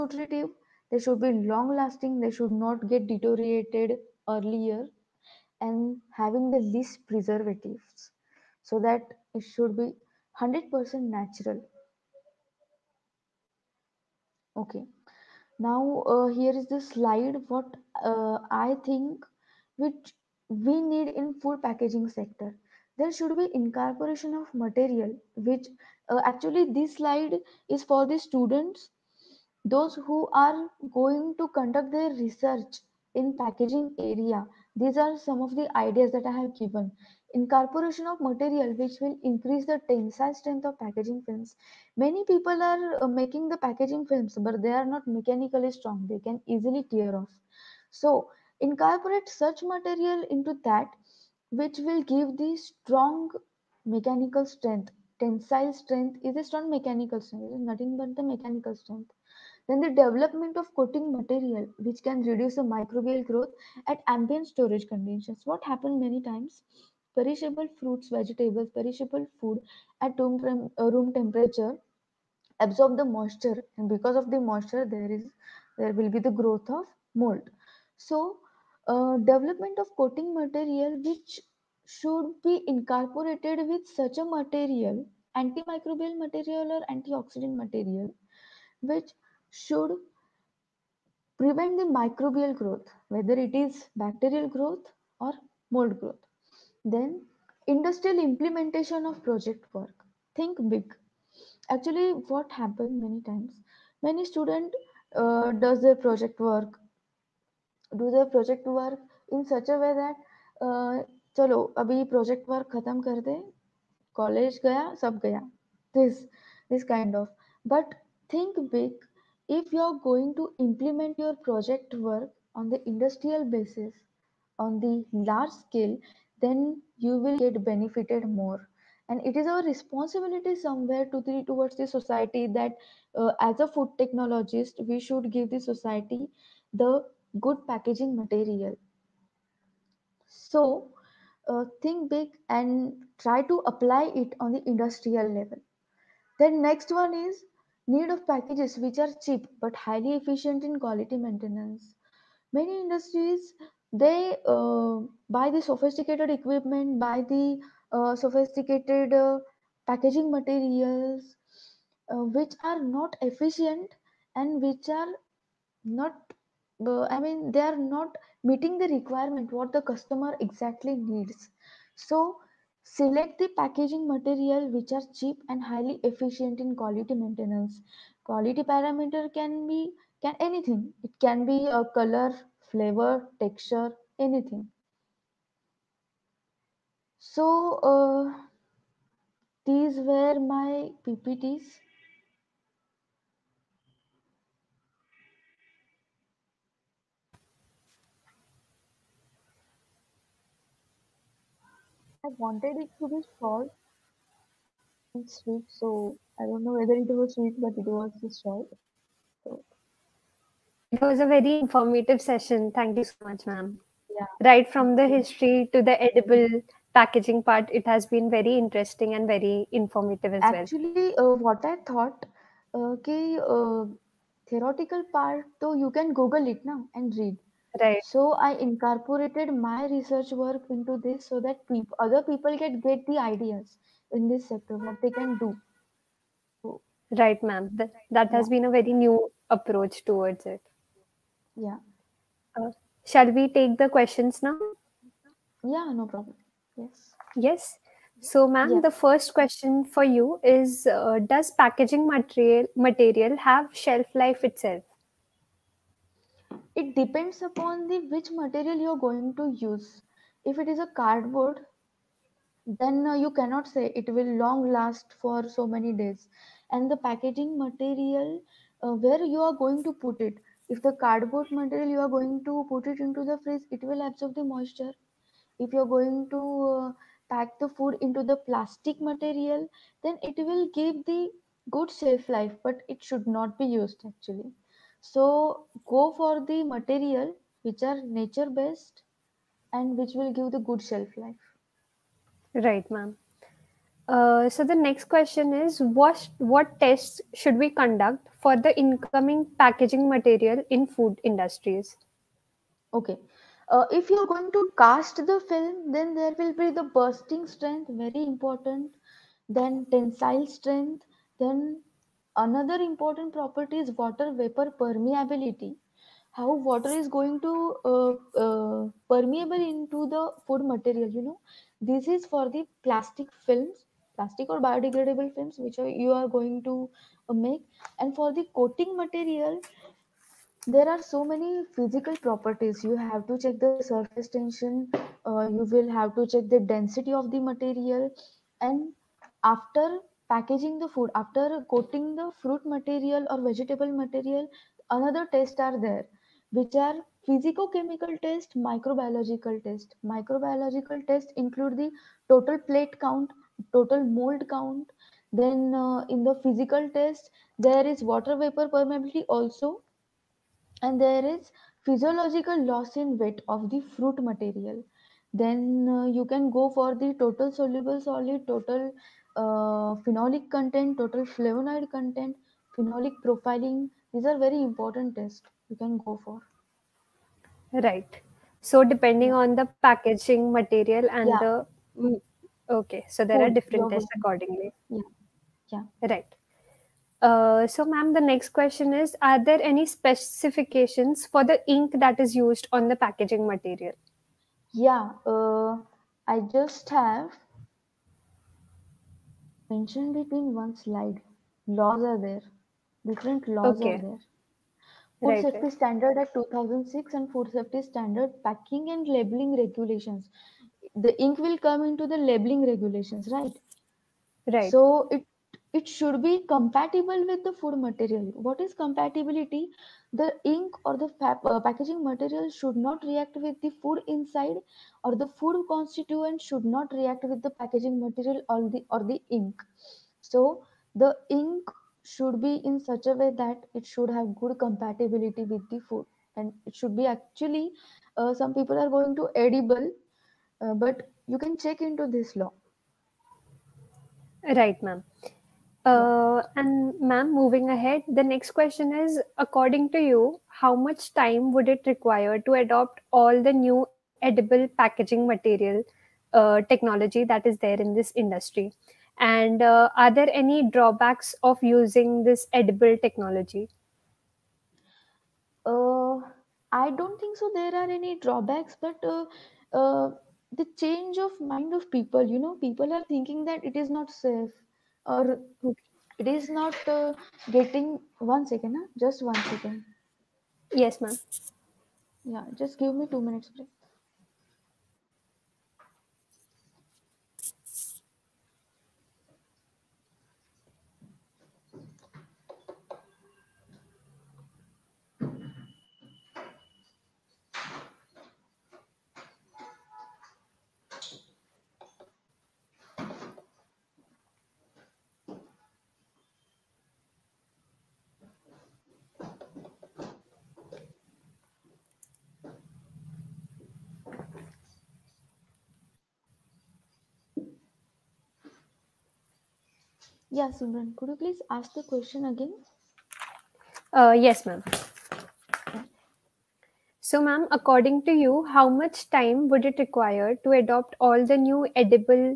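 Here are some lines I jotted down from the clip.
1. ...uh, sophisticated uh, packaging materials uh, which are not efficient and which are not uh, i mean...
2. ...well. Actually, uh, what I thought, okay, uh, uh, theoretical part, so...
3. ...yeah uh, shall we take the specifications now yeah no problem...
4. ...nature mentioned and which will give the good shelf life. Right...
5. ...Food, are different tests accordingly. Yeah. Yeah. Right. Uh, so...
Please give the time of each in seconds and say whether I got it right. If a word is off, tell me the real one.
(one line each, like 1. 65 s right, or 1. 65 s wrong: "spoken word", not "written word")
1. 157 s right
2. 220 s right
3. 241 s wrong: "questions", not "specifications"
4. 288 s wrong: "based", not "mentioned"
5. 383 s right.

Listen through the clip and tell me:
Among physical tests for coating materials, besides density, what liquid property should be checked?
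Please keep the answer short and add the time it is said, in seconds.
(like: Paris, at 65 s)
Surface tension, at 333 s.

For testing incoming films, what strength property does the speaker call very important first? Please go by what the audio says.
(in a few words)
Bursting strength.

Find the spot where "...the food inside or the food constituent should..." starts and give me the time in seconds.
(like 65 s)
423 s.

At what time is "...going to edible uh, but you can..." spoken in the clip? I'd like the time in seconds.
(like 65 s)
438 s.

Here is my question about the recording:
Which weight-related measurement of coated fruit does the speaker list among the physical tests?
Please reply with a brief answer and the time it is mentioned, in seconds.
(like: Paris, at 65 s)
Physiological loss in weight, at 361 s.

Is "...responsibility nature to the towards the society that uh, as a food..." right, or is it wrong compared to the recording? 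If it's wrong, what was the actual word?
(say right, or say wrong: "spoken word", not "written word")
wrong: "somewhere", not "nature".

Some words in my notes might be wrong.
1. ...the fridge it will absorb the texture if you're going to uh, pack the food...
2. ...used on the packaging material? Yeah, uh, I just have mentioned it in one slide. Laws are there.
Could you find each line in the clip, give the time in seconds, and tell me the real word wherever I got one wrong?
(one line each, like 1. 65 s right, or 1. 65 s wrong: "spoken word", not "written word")
1. 273 s wrong: "moisture", not "texture"
2. 392 s right.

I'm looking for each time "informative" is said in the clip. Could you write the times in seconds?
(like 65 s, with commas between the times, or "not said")
211 s, 219 s.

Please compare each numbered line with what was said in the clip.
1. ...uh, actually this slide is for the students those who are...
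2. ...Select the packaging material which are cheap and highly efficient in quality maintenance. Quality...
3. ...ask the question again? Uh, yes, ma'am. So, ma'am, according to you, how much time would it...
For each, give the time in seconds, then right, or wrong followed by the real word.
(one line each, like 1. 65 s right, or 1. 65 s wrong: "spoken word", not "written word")
1. 26 s right
2. 172 s right
3. 521 s right.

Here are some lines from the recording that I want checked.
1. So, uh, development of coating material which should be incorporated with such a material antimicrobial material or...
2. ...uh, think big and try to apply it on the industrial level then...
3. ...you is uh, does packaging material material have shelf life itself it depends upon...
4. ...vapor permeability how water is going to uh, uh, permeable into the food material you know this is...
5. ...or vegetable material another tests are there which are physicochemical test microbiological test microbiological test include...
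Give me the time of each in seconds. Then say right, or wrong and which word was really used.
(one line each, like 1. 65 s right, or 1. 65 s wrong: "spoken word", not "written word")
1. 77 s right
2. 141 s right
3. 250 s right
4. 314 s right
5. 343 s right.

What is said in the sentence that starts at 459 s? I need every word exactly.
And uh, are there any drawbacks of using this edible technology?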